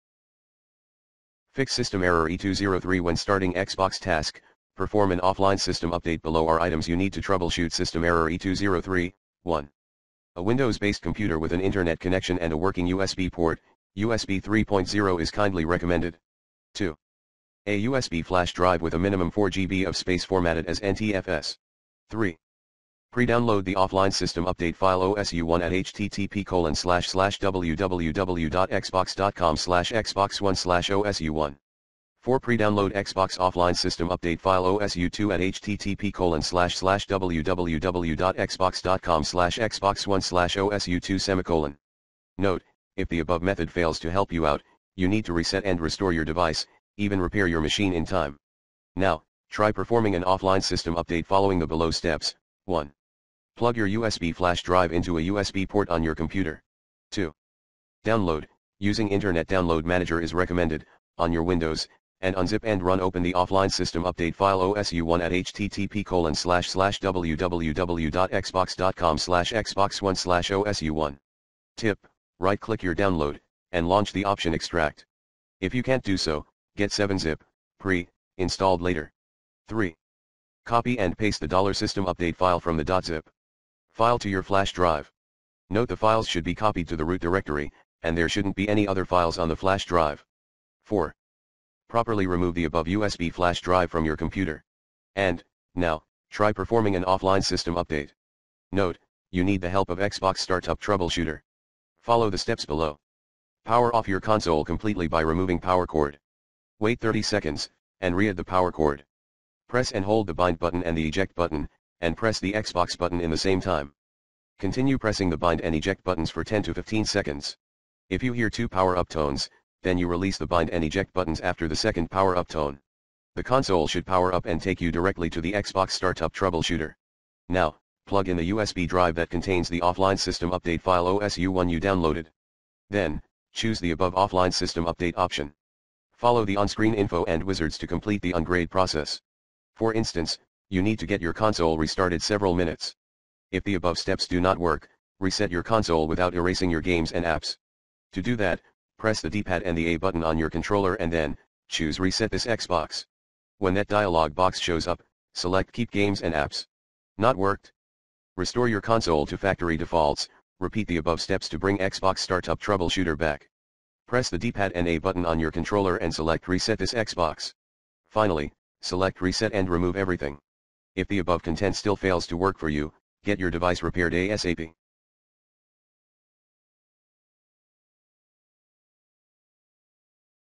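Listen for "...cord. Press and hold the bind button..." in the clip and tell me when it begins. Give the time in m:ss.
1:48.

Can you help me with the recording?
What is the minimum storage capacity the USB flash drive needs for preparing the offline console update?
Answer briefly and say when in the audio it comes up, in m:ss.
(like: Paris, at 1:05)
4 GB, at 0:19.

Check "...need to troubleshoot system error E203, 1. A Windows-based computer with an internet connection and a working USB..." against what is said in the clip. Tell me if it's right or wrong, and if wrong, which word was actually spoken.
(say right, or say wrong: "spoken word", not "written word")
right.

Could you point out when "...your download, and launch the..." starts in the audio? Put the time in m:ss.
1:12.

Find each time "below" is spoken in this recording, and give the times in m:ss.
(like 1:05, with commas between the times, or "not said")
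0:06, 0:51, 1:42.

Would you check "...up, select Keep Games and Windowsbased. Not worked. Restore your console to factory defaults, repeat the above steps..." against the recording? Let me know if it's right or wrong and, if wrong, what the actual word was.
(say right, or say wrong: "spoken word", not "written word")
wrong: "Apps", not "Windowsbased".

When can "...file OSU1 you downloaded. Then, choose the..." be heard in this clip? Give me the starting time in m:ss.
2:10.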